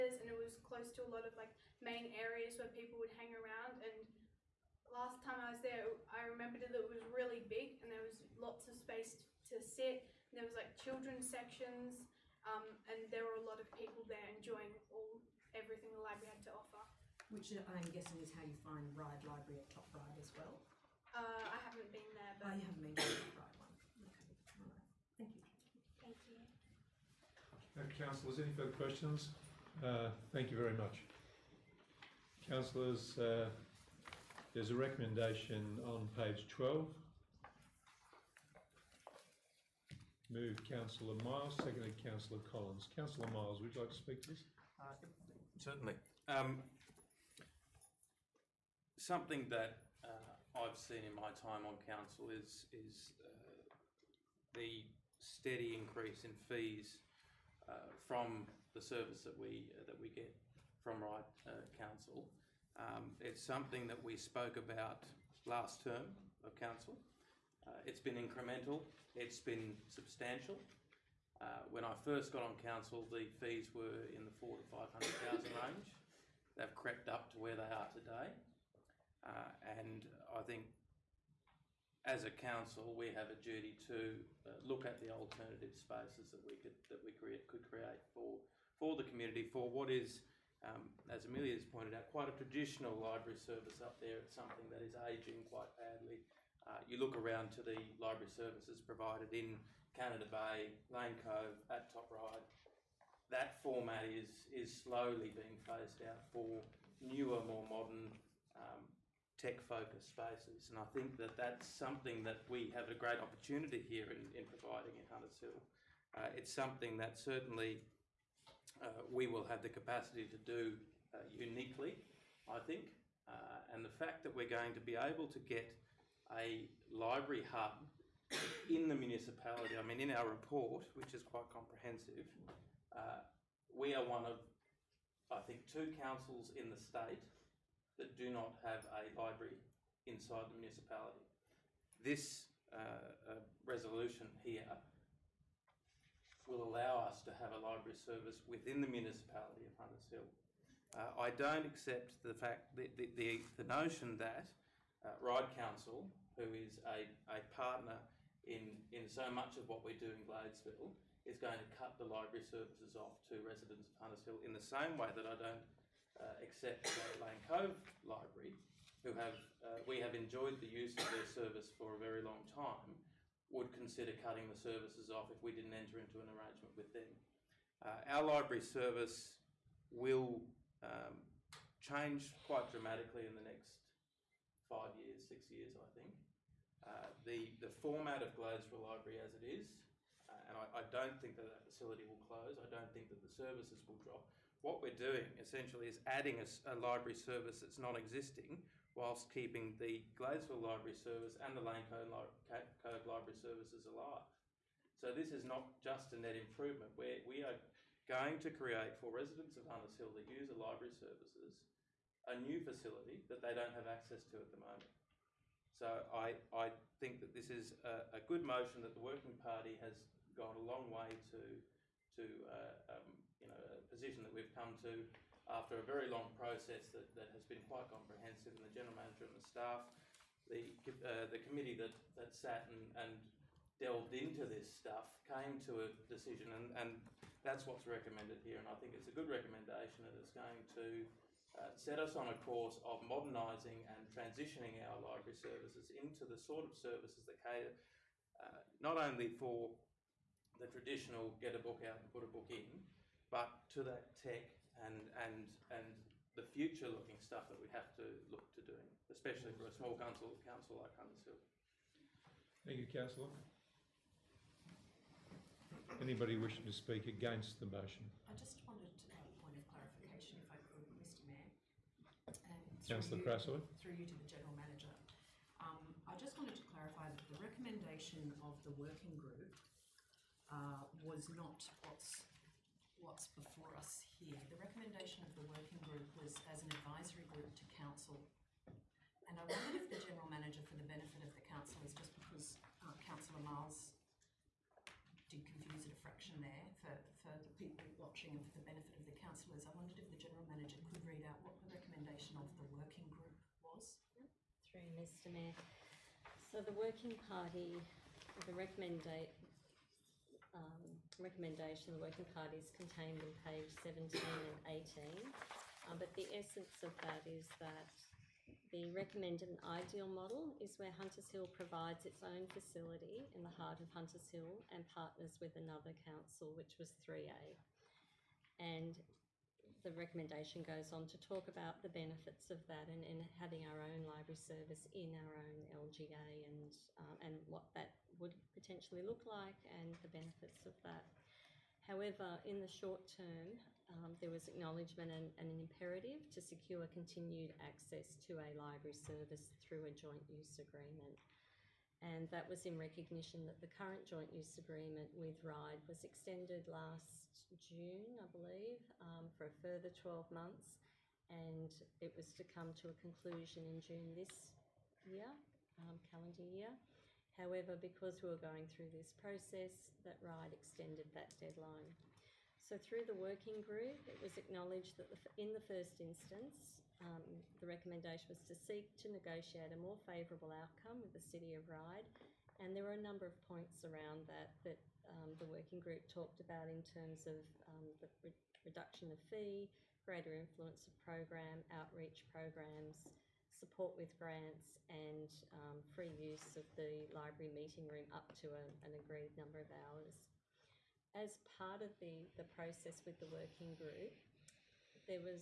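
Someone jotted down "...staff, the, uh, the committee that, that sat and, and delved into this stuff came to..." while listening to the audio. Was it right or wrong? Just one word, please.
right.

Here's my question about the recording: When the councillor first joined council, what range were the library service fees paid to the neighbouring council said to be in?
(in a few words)
$400,000 to $500,000.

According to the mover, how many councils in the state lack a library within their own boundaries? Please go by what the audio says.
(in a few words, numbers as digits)
2.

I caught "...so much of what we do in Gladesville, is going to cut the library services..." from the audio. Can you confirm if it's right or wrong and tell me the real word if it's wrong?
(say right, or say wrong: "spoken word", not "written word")
right.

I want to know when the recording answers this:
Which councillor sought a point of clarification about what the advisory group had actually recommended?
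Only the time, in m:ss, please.
4:32.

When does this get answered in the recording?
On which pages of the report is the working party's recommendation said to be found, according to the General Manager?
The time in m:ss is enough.
5:13.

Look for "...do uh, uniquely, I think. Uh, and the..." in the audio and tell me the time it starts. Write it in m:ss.
2:00.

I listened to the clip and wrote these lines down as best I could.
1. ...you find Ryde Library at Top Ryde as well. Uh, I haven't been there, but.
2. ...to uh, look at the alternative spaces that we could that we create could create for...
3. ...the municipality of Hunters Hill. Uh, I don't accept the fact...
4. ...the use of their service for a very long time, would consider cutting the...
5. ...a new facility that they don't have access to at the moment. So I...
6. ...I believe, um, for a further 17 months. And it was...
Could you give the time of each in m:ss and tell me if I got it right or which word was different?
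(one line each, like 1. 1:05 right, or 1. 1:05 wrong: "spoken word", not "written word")
1. 0:18 right
2. 1:23 right
3. 2:28 right
4. 2:50 right
5. 3:32 right
6. 5:58 wrong: "12", not "17".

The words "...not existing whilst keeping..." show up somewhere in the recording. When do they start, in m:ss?
3:17.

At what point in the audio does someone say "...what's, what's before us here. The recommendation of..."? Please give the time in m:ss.
4:41.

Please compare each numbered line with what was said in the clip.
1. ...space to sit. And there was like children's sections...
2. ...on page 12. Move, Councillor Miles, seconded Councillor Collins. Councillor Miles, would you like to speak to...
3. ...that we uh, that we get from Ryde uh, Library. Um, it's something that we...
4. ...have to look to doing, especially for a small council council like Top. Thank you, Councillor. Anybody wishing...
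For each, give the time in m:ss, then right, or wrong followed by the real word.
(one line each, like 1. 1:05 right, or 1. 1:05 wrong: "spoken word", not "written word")
1. 0:08 right
2. 0:35 right
3. 0:59 wrong: "Council", not "Library"
4. 4:17 wrong: "Huntersville", not "Top".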